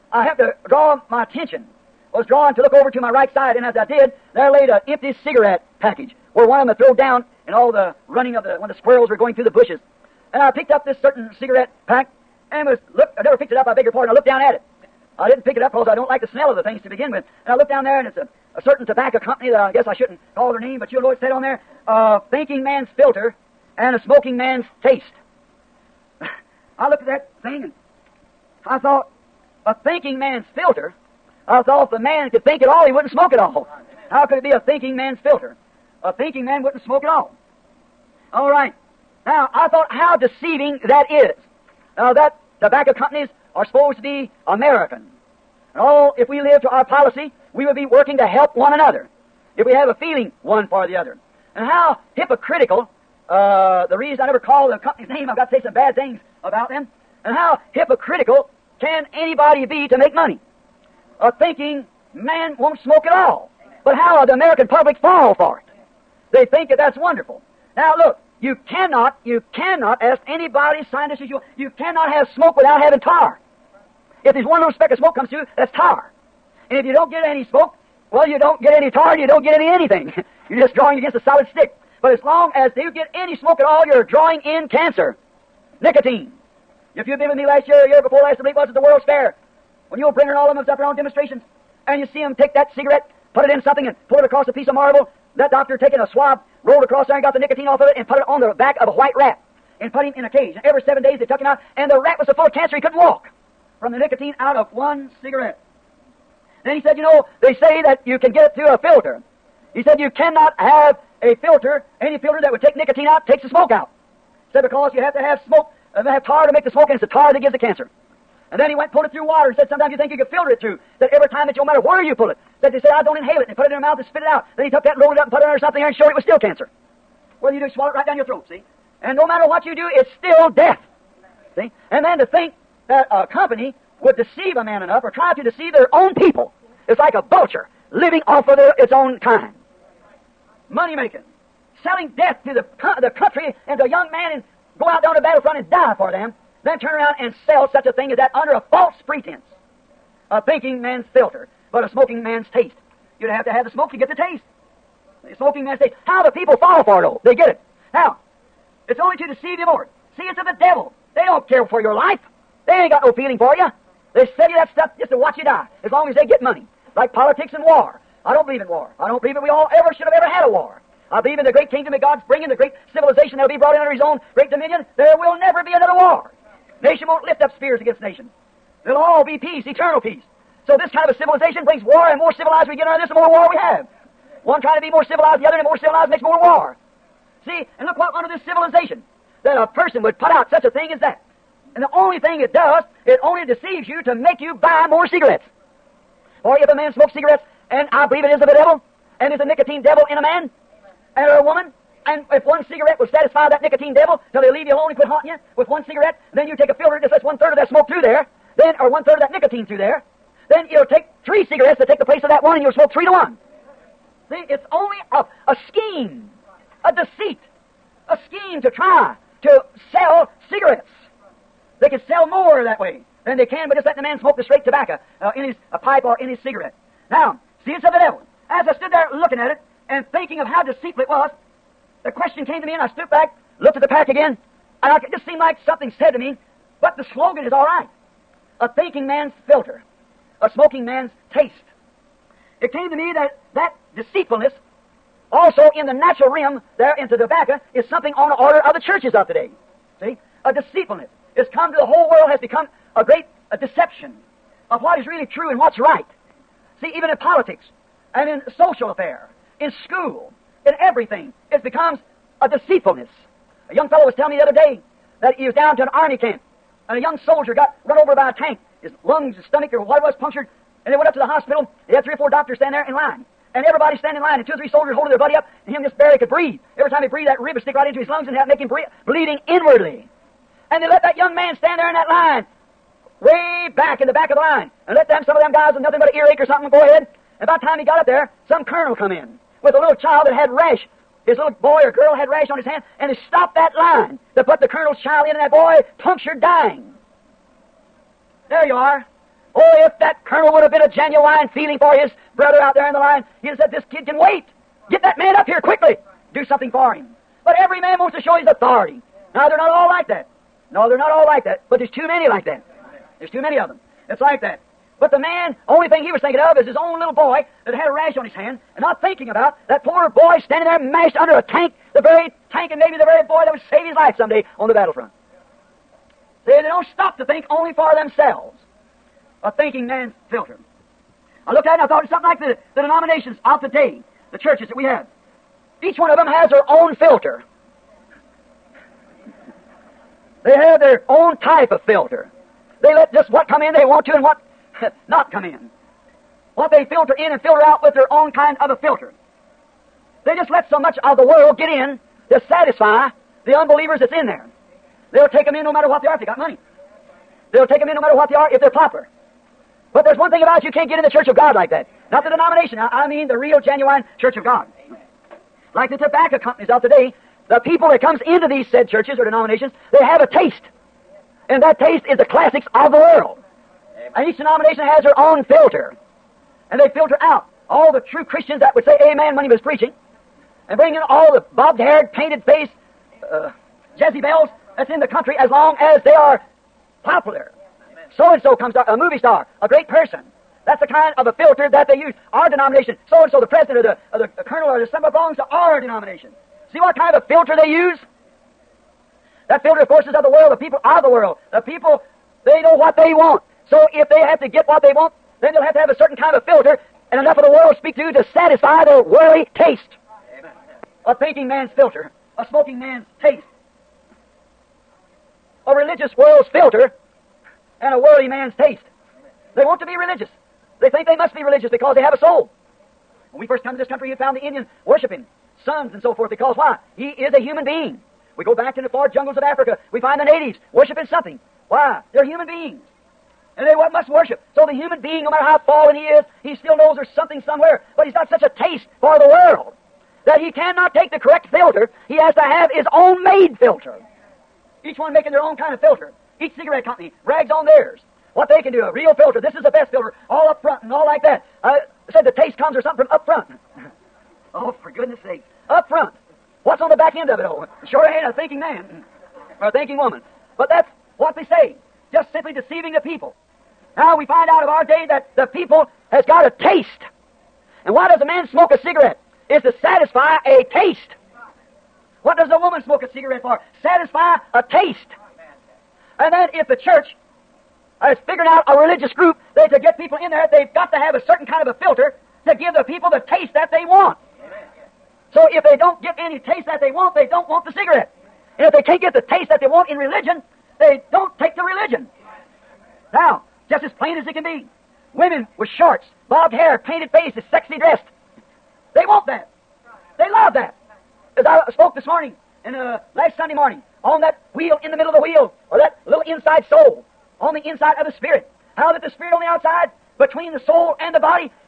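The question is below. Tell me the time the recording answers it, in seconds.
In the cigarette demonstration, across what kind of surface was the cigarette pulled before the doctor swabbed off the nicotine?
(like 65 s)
94 s.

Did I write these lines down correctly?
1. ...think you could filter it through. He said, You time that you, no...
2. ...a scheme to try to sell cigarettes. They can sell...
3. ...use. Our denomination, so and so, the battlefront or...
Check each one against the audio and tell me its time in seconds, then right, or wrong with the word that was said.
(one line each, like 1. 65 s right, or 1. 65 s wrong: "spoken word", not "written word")
1. 119 s wrong: "Every", not "You"
2. 218 s right
3. 391 s wrong: "president", not "battlefront".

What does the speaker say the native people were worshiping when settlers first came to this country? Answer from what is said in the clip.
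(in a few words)
suns.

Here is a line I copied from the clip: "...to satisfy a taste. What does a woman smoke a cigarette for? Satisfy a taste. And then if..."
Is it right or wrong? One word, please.
right.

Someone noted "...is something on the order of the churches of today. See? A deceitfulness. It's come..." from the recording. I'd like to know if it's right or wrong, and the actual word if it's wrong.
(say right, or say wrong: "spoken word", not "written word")
right.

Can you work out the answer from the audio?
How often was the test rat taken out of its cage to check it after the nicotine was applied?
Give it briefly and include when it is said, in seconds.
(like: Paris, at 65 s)
every 7 days, at 100 s.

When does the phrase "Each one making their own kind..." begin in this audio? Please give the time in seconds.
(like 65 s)
444 s.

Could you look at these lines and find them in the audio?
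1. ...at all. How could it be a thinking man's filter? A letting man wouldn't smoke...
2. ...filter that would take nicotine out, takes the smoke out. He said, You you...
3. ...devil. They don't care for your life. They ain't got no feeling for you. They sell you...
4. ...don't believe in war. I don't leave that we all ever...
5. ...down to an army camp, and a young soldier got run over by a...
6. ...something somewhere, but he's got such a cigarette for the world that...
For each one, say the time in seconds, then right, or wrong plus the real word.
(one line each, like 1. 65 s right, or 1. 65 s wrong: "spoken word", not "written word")
1. 33 s wrong: "thinking", not "letting"
2. 112 s wrong: "Because", not "You"
3. 160 s right
4. 168 s wrong: "believe", not "leave"
5. 265 s right
6. 437 s wrong: "taste", not "cigarette".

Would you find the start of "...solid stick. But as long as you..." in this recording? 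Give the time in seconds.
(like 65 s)
81 s.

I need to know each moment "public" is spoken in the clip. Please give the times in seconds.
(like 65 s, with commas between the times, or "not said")
64 s.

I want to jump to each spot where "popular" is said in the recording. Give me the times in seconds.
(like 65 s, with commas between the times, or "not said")
358 s, 387 s.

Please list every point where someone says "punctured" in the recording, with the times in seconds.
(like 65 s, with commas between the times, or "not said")
270 s, 295 s.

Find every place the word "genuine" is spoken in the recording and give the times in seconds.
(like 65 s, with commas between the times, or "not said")
300 s, 363 s.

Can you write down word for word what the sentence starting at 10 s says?
And I picked up this certain cigarette pack and was looked.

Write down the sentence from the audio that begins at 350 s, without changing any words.
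They just let so much of the world get in to satisfy the unbelievers that's in there.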